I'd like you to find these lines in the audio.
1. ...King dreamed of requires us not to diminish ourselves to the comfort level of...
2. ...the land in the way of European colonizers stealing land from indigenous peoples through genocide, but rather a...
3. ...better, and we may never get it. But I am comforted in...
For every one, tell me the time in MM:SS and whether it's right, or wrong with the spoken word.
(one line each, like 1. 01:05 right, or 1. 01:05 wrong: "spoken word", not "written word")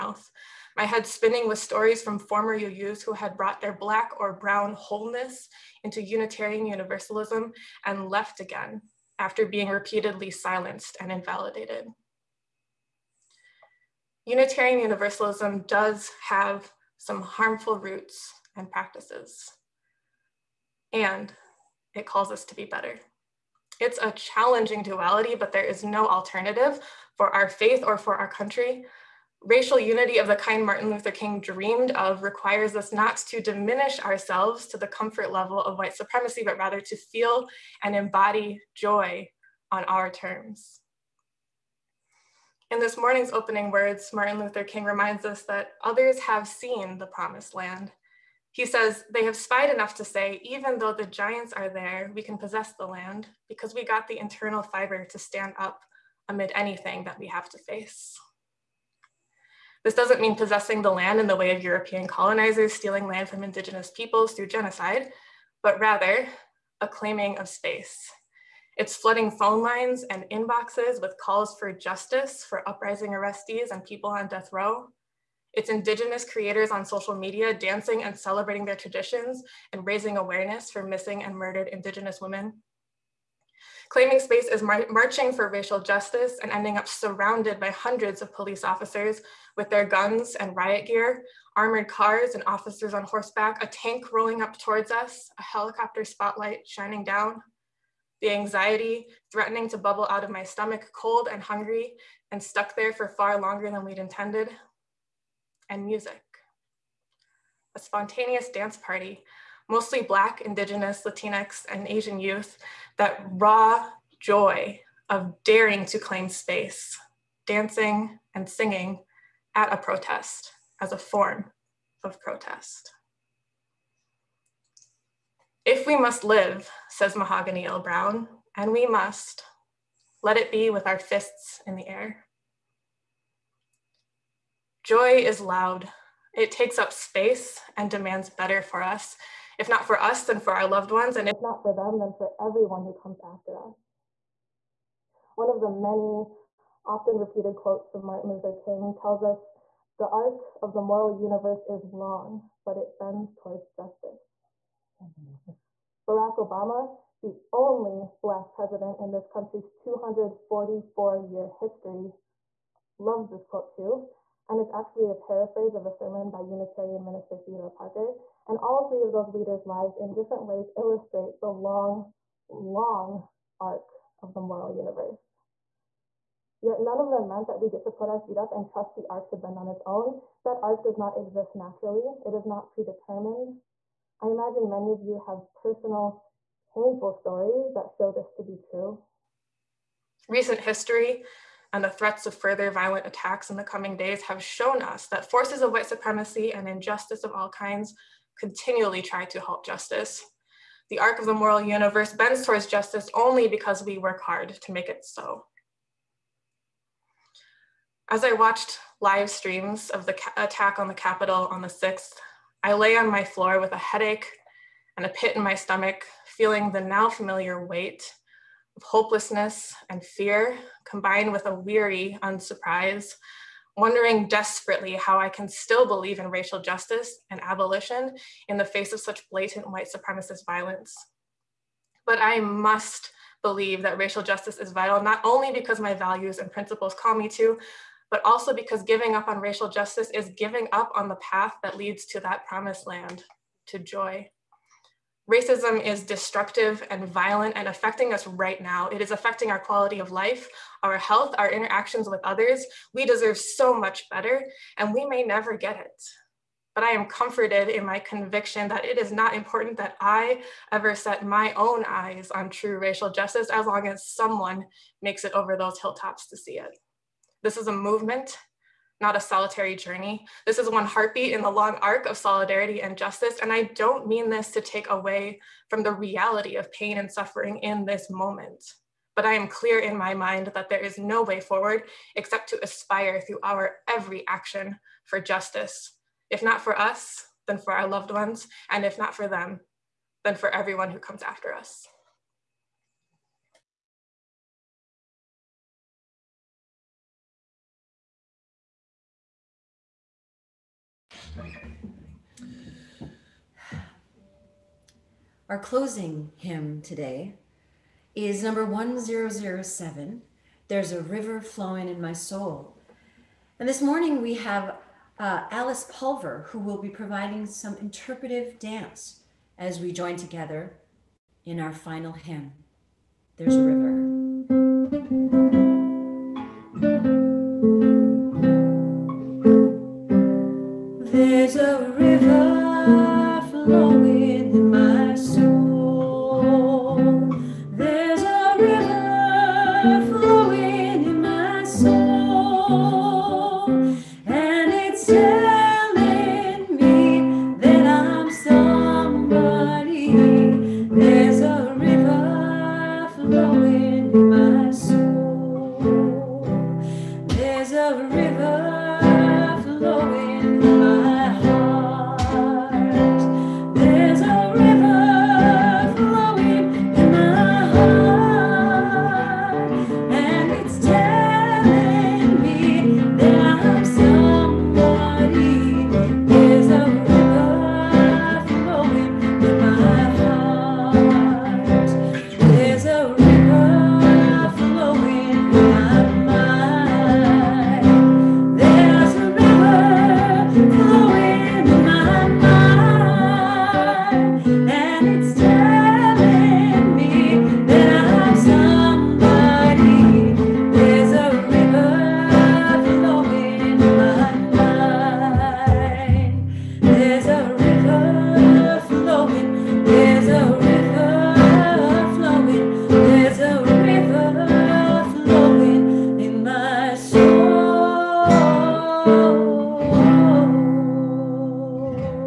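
1. 00:31 right
2. 01:00 right
3. 04:14 right.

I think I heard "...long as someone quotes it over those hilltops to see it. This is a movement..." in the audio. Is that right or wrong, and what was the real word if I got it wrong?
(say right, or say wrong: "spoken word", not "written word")
wrong: "makes", not "quotes".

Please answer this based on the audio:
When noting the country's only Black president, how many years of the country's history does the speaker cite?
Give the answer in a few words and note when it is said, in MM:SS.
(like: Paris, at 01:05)
244, at 02:39.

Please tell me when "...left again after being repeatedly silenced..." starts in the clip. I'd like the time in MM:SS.
00:08.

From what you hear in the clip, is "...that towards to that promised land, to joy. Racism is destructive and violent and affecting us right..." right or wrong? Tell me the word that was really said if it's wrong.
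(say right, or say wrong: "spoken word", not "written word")
wrong: "leads", not "towards".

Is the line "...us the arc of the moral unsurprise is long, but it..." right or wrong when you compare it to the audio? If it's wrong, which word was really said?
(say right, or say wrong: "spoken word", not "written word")
wrong: "universe", not "unsurprise".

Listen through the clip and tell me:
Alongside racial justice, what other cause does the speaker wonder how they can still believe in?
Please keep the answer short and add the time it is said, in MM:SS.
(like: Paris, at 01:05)
abolition, at 03:47.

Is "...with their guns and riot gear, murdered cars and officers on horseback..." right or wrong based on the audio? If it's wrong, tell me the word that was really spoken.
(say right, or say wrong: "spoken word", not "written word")
wrong: "armored", not "murdered".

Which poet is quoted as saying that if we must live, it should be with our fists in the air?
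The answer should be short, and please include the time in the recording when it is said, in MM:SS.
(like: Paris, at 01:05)
Mahogany L. Browne, at 02:07.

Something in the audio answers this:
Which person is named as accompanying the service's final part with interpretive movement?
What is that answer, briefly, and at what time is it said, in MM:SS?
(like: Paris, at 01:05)
Alice Pulver, at 05:15.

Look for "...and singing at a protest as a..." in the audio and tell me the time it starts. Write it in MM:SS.
01:58.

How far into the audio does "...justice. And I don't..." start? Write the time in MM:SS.
04:32.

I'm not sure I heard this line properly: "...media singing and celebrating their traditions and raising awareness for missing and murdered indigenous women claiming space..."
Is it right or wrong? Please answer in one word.
wrong.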